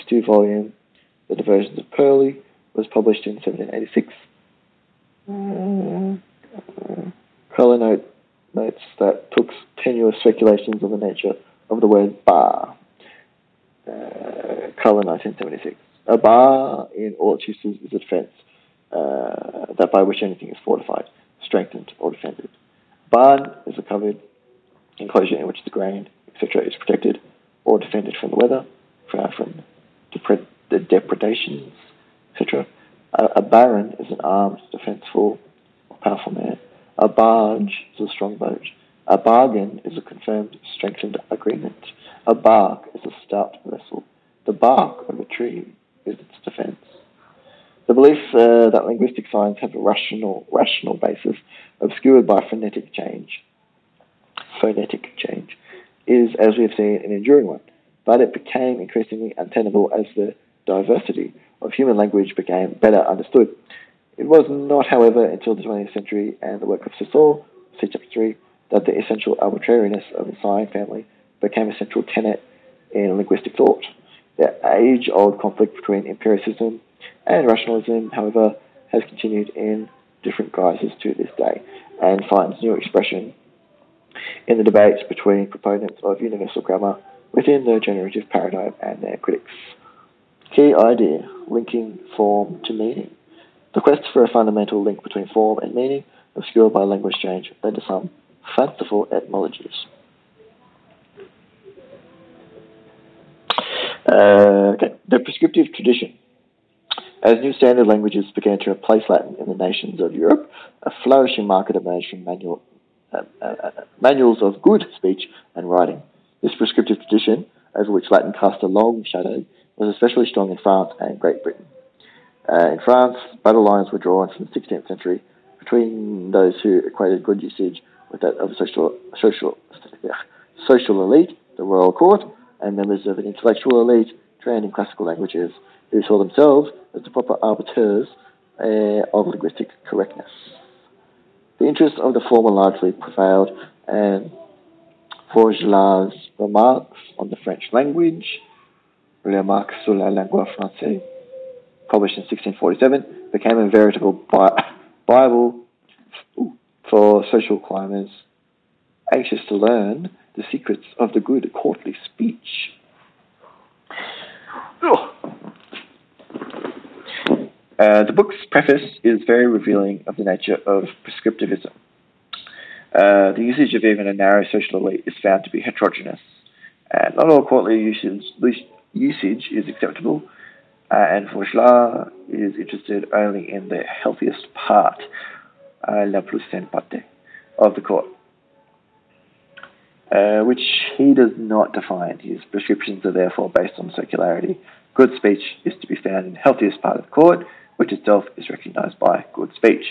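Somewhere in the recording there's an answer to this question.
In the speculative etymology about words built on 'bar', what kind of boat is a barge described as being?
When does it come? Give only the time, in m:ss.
0:36.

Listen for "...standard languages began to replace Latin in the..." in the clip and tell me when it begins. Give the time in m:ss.
1:47.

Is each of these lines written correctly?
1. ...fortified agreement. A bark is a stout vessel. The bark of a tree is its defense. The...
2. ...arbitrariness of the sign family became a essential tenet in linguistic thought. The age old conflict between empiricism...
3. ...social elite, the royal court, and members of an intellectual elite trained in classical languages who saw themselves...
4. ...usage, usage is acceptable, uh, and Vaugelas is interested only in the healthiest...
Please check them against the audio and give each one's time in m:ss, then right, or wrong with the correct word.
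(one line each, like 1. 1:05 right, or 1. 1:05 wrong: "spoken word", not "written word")
1. 0:40 wrong: "strengthened", not "fortified"
2. 1:09 wrong: "central", not "essential"
3. 2:10 right
4. 2:57 right.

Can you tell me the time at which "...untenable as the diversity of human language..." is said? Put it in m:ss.
0:59.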